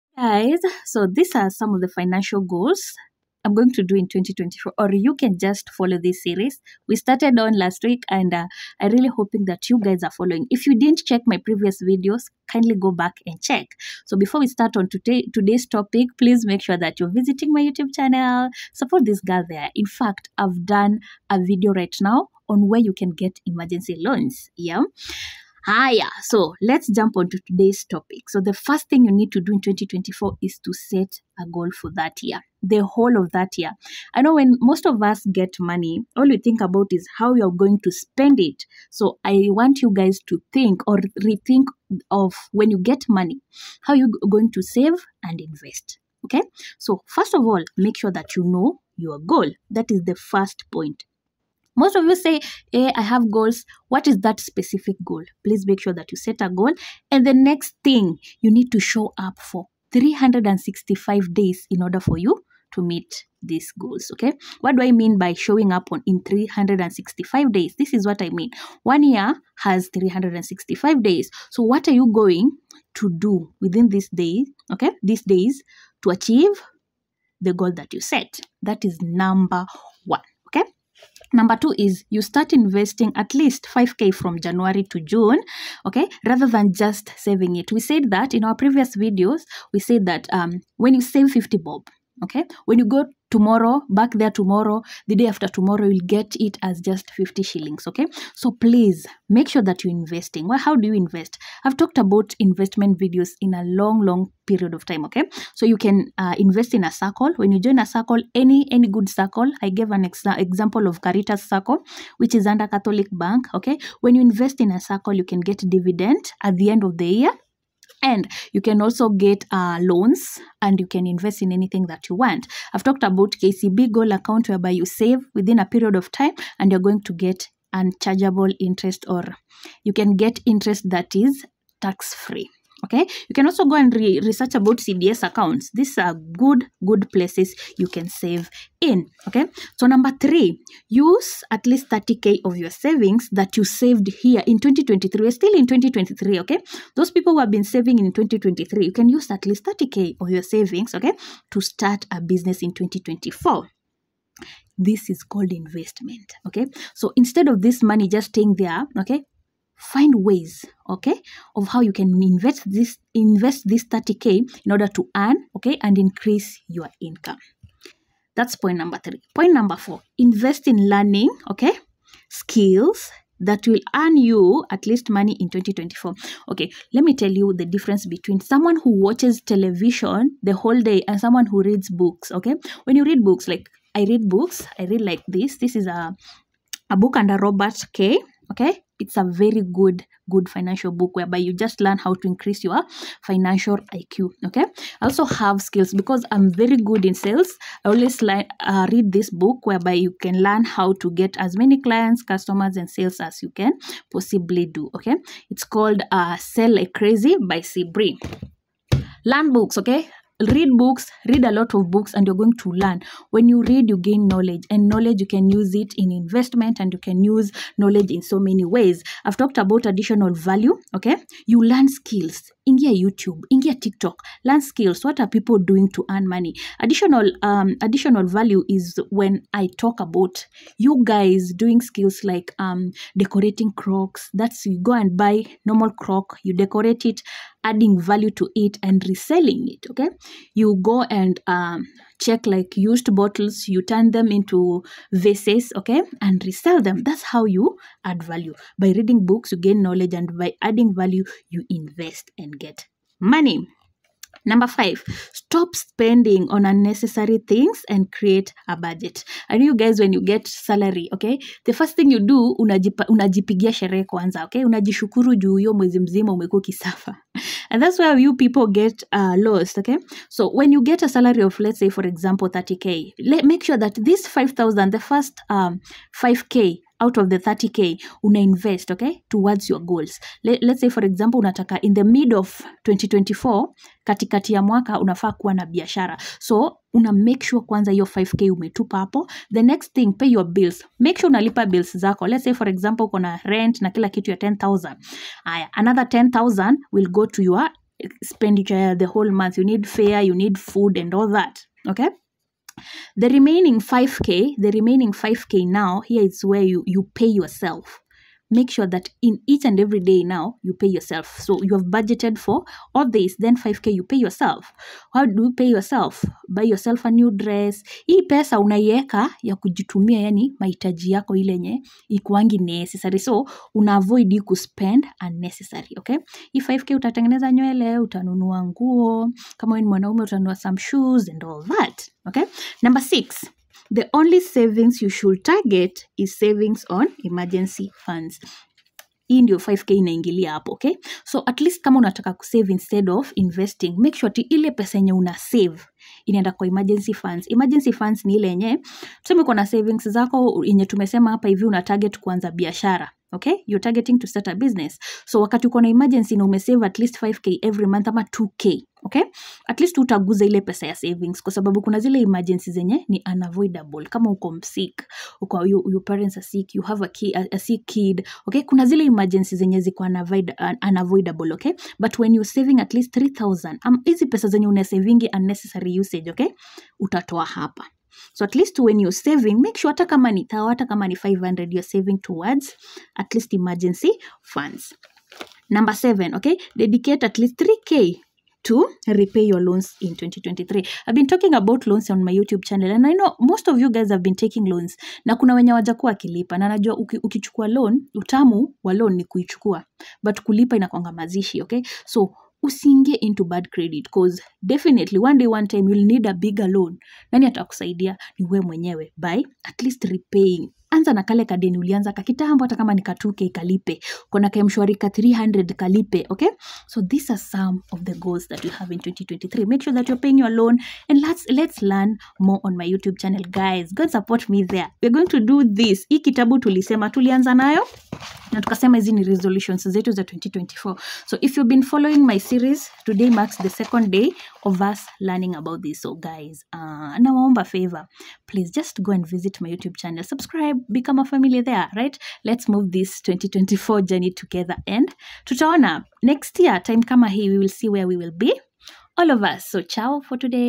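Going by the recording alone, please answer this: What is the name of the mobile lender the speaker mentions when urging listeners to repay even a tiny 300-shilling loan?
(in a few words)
M-Shwari.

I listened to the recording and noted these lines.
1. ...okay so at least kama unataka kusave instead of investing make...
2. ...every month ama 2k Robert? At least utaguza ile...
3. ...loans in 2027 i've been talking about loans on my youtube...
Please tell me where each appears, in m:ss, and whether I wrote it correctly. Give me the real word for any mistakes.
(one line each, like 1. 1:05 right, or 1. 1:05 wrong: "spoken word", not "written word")
1. 5:40 right
2. 5:57 wrong: "Okay", not "Robert"
3. 6:29 wrong: "2023", not "2027".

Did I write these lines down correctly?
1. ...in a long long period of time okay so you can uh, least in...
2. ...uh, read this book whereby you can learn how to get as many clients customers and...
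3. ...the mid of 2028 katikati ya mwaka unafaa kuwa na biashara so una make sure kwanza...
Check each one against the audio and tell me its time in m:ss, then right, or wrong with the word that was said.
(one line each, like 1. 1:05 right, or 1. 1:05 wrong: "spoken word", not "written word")
1. 1:43 wrong: "invest", not "least"
2. 3:18 right
3. 4:41 wrong: "2024", not "2028".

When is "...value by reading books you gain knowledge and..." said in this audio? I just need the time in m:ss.
4:08.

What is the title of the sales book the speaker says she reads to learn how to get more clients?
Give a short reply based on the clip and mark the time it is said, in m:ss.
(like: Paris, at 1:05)
Sell Like Crazy, at 3:26.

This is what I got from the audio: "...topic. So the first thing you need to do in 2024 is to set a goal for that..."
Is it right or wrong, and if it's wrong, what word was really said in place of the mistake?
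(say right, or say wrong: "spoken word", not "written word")
right.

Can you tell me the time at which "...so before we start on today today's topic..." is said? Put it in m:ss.
0:14.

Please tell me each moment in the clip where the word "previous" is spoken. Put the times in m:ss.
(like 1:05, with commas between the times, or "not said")
0:11, 1:28.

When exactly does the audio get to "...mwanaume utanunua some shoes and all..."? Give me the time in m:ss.
5:29.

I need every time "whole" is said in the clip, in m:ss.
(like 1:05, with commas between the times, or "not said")
0:32, 3:00, 4:59.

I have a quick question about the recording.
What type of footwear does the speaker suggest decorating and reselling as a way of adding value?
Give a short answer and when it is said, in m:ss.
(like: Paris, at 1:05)
Crocs, at 3:53.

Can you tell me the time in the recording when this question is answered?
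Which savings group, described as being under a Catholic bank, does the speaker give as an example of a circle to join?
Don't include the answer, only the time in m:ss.
1:51.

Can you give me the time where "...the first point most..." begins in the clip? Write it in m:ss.
0:50.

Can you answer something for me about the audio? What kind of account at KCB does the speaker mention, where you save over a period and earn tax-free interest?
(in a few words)
Goal account.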